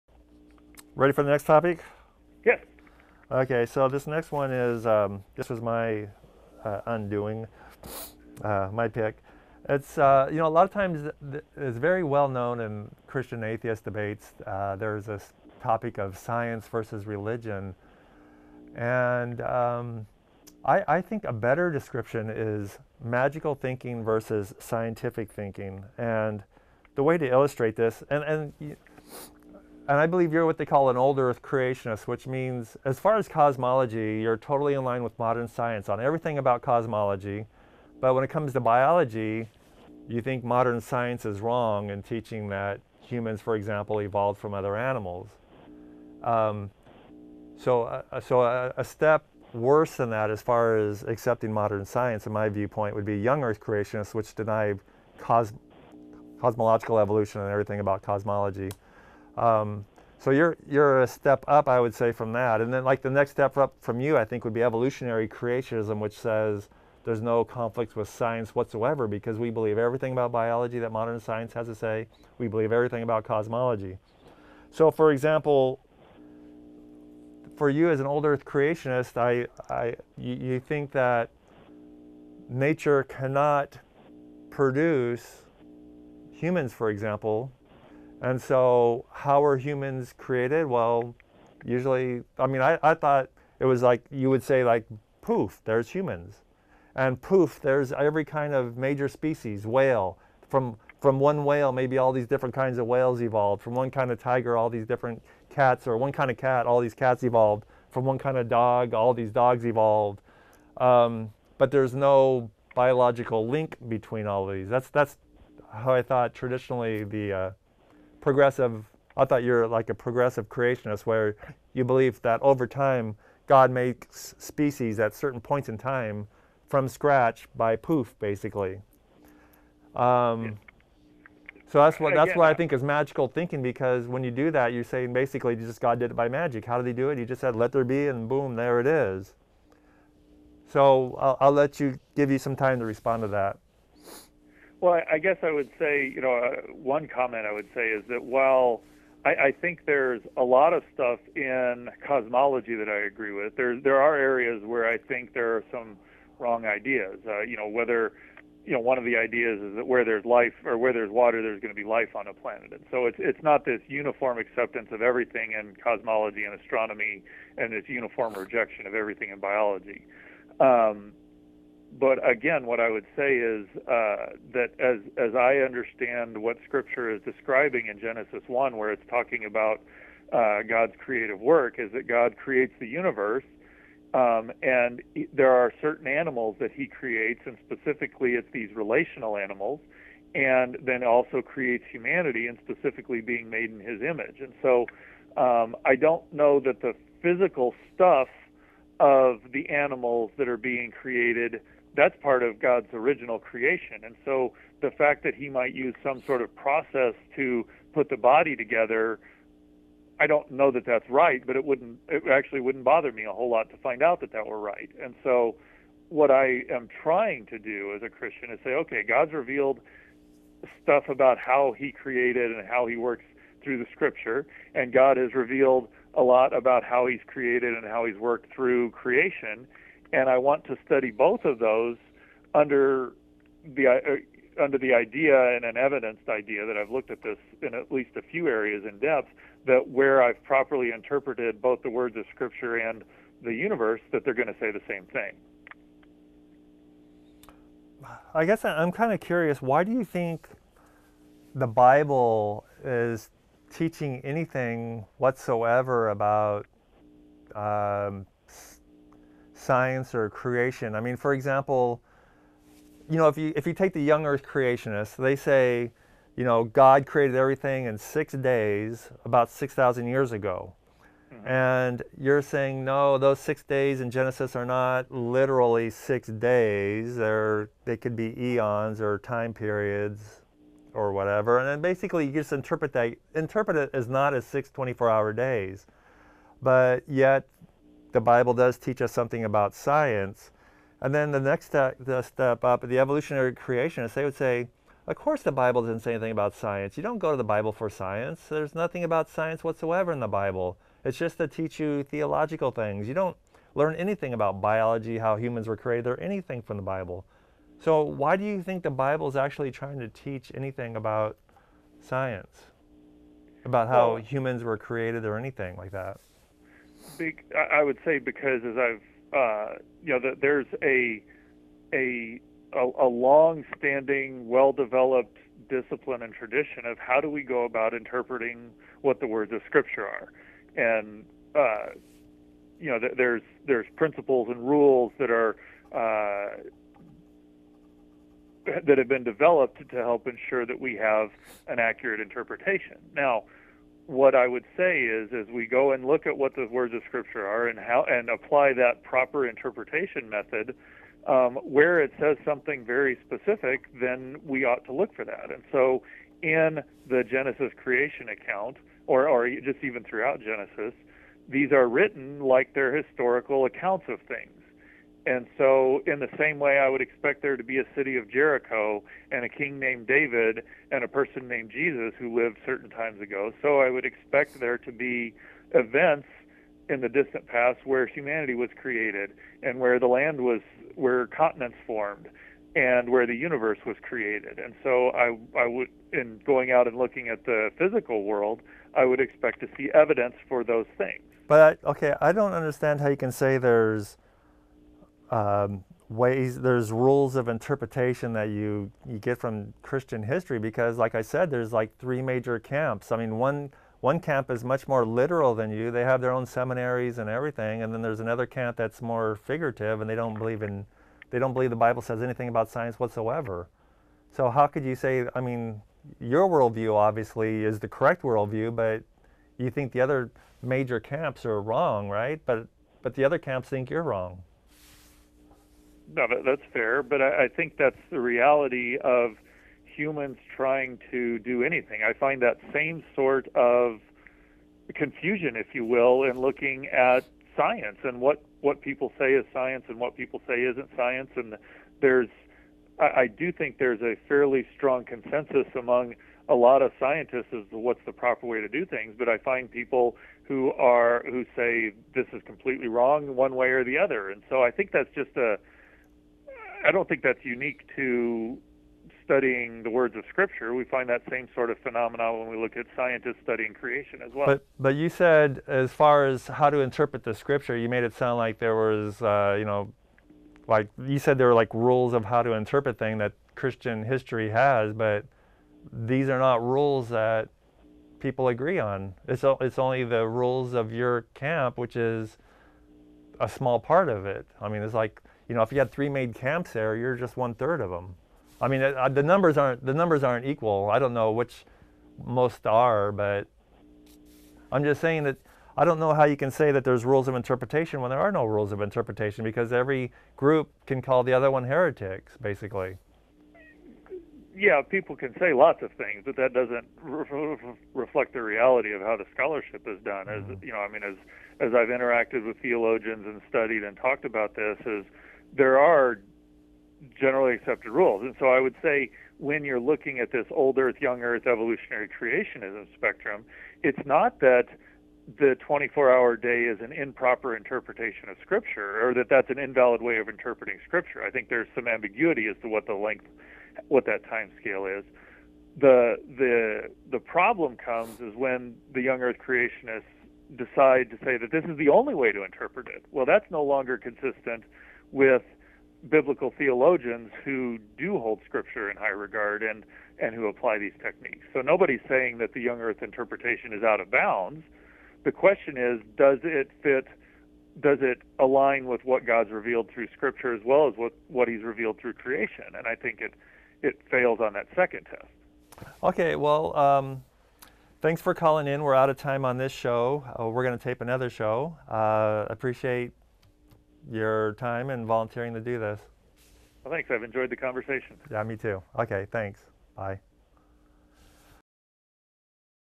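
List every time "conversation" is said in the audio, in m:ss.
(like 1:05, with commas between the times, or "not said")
9:37.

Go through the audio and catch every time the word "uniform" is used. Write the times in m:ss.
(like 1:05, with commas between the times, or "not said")
2:43, 2:47.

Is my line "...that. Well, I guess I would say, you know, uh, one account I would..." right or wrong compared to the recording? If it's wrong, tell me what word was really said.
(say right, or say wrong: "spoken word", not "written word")
wrong: "comment", not "account".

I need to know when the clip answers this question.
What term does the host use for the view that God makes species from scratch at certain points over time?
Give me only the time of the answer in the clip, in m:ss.
1:59.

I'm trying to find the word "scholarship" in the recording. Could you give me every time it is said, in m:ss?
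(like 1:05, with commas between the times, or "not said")
8:29.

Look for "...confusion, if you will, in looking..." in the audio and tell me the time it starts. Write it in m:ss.
7:14.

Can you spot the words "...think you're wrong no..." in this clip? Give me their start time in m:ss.
7:03.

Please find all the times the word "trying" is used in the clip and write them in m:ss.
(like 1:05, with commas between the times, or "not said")
3:37, 5:09, 7:10.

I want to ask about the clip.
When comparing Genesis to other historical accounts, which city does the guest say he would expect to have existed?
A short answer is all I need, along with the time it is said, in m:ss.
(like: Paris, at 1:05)
Jericho, at 6:08.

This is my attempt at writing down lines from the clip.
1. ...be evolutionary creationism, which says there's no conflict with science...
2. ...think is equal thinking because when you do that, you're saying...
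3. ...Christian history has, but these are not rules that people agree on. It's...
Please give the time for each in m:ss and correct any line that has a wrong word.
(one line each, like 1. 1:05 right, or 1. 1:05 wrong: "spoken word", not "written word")
1. 1:04 right
2. 2:12 wrong: "magical", not "equal"
3. 7:53 right.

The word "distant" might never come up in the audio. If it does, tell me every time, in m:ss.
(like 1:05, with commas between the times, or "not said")
6:17.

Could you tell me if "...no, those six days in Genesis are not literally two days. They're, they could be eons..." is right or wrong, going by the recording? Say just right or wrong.
wrong.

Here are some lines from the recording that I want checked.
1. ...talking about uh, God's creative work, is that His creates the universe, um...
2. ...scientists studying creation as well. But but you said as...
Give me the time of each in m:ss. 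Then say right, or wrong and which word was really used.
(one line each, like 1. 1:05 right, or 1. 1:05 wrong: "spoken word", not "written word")
1. 2:59 wrong: "God", not "His"
2. 7:42 right.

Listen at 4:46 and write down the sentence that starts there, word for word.
But yet the Bible does teach us something about science.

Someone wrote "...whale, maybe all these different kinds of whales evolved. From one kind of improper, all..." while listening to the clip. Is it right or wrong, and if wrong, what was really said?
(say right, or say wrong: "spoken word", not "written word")
wrong: "tiger", not "improper".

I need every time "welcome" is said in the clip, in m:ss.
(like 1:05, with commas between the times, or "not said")
not said.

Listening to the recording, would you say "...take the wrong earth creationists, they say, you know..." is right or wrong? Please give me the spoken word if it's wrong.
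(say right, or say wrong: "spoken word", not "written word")
wrong: "young", not "wrong".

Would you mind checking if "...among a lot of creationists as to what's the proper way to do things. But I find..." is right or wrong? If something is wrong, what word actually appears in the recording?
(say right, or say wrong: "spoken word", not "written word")
wrong: "scientists", not "creationists".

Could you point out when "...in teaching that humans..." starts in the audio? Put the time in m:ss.
0:41.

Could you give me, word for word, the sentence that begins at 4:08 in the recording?
I guess I'm kind of curious.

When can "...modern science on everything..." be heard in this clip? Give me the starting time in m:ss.
0:35.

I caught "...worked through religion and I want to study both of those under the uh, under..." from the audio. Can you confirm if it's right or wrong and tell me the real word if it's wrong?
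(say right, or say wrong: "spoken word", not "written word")
wrong: "creation", not "religion".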